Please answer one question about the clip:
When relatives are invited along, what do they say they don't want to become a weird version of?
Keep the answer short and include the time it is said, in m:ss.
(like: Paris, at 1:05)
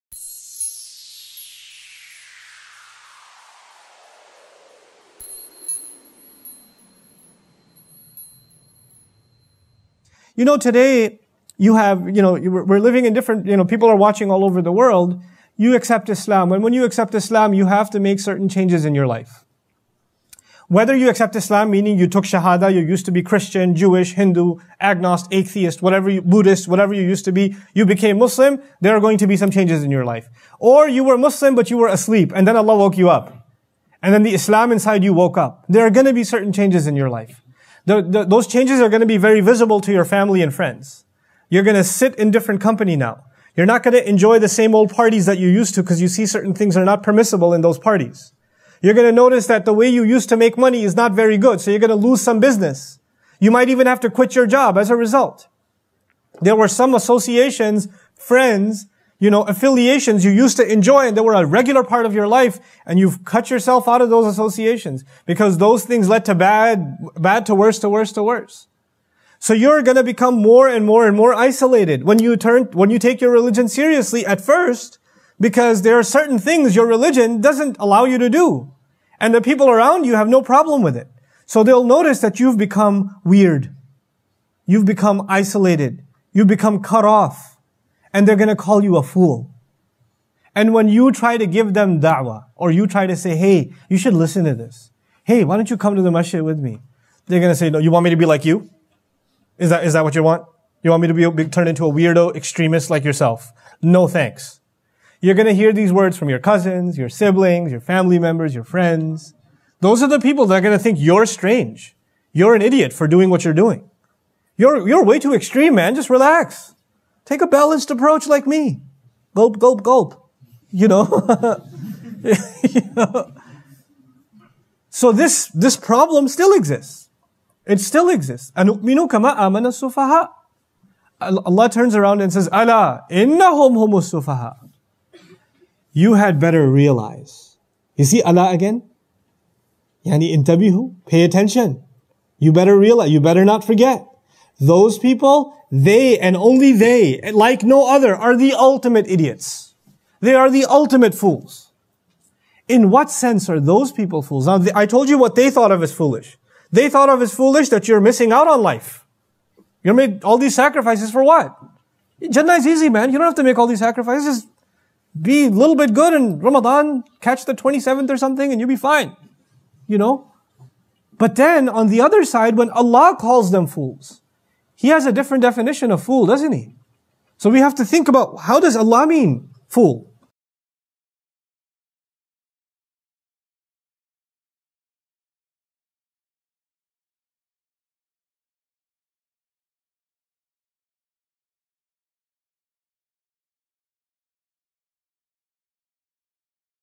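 extremist, at 1:42.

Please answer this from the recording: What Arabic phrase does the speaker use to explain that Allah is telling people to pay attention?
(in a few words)
intabihu.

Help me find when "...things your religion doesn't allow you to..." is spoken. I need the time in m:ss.
1:16.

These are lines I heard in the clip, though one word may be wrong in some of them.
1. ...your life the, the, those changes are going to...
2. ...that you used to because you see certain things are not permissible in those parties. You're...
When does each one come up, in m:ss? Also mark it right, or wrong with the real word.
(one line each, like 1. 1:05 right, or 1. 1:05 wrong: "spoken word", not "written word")
1. 0:36 right
2. 0:45 right.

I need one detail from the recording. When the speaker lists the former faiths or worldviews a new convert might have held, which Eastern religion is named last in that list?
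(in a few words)
Buddhist.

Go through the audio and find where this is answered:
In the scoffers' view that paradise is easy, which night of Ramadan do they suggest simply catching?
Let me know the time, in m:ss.
2:47.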